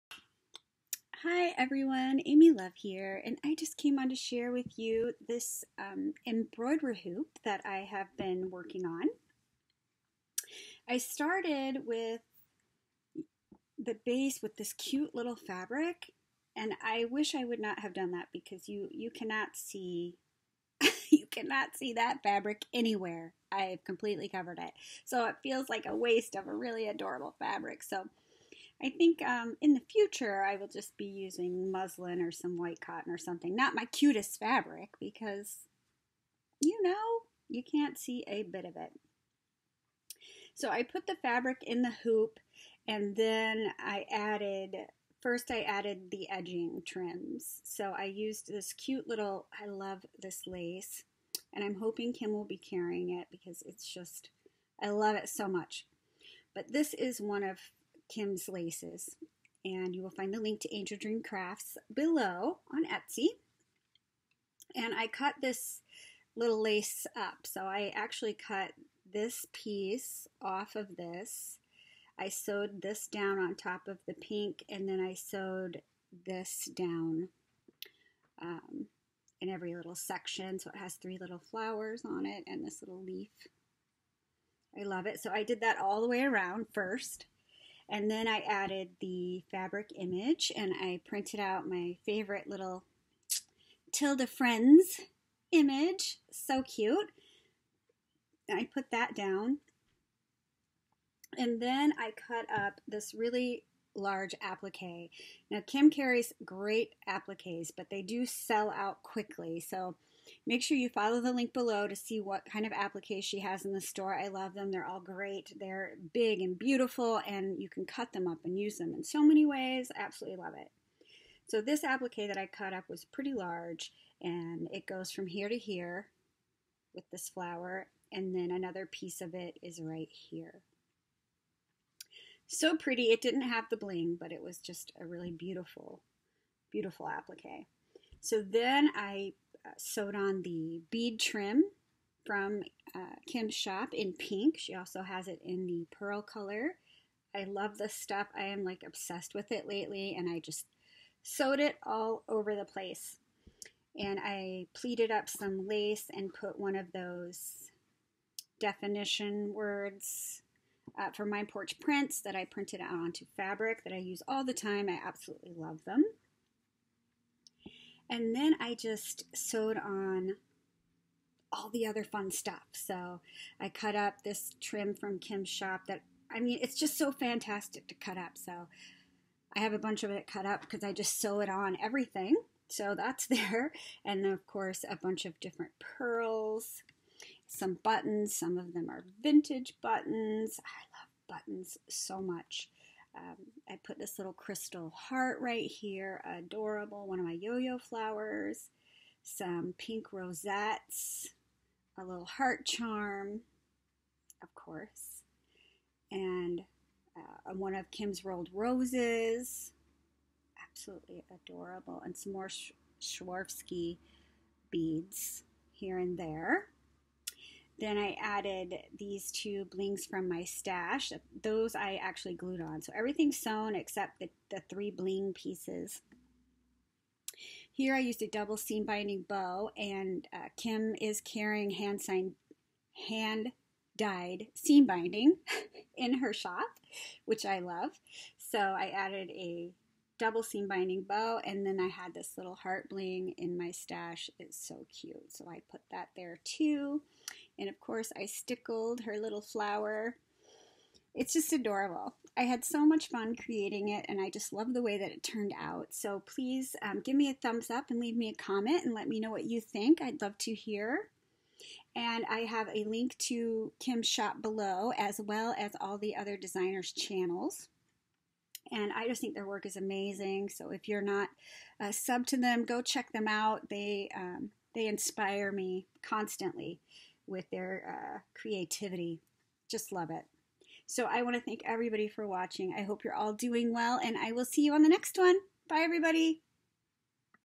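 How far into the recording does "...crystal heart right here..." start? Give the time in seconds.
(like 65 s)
194 s.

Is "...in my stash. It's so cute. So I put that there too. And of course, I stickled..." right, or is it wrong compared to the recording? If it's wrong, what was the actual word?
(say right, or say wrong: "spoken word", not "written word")
right.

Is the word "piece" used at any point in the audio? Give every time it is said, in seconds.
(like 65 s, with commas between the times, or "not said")
69 s, 128 s, 225 s.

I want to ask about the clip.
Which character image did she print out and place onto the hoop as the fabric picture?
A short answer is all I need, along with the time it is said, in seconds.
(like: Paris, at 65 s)
Tilda Friends, at 93 s.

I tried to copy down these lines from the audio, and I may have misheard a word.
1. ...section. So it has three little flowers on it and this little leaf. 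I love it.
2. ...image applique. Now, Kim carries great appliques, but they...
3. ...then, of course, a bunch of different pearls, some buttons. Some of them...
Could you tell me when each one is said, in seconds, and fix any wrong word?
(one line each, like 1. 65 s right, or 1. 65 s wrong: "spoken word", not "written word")
1. 79 s right
2. 103 s wrong: "large", not "image"
3. 184 s right.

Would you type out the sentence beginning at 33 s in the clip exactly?
Not my cutest fabric because, you know, you can't see a bit of it.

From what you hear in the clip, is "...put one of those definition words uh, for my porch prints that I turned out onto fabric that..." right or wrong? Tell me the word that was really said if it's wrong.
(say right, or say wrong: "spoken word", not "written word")
wrong: "printed", not "turned".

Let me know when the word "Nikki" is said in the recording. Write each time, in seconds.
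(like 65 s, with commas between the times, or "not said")
not said.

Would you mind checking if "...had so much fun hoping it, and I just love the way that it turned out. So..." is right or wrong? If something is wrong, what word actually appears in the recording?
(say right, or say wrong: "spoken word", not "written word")
wrong: "creating", not "hoping".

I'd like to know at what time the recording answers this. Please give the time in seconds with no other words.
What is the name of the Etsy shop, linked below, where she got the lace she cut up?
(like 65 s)
60 s.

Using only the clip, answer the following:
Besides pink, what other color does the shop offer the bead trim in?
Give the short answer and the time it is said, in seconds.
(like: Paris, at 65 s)
Pearl, at 145 s.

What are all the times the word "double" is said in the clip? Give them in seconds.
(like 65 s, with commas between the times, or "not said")
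228 s, 240 s.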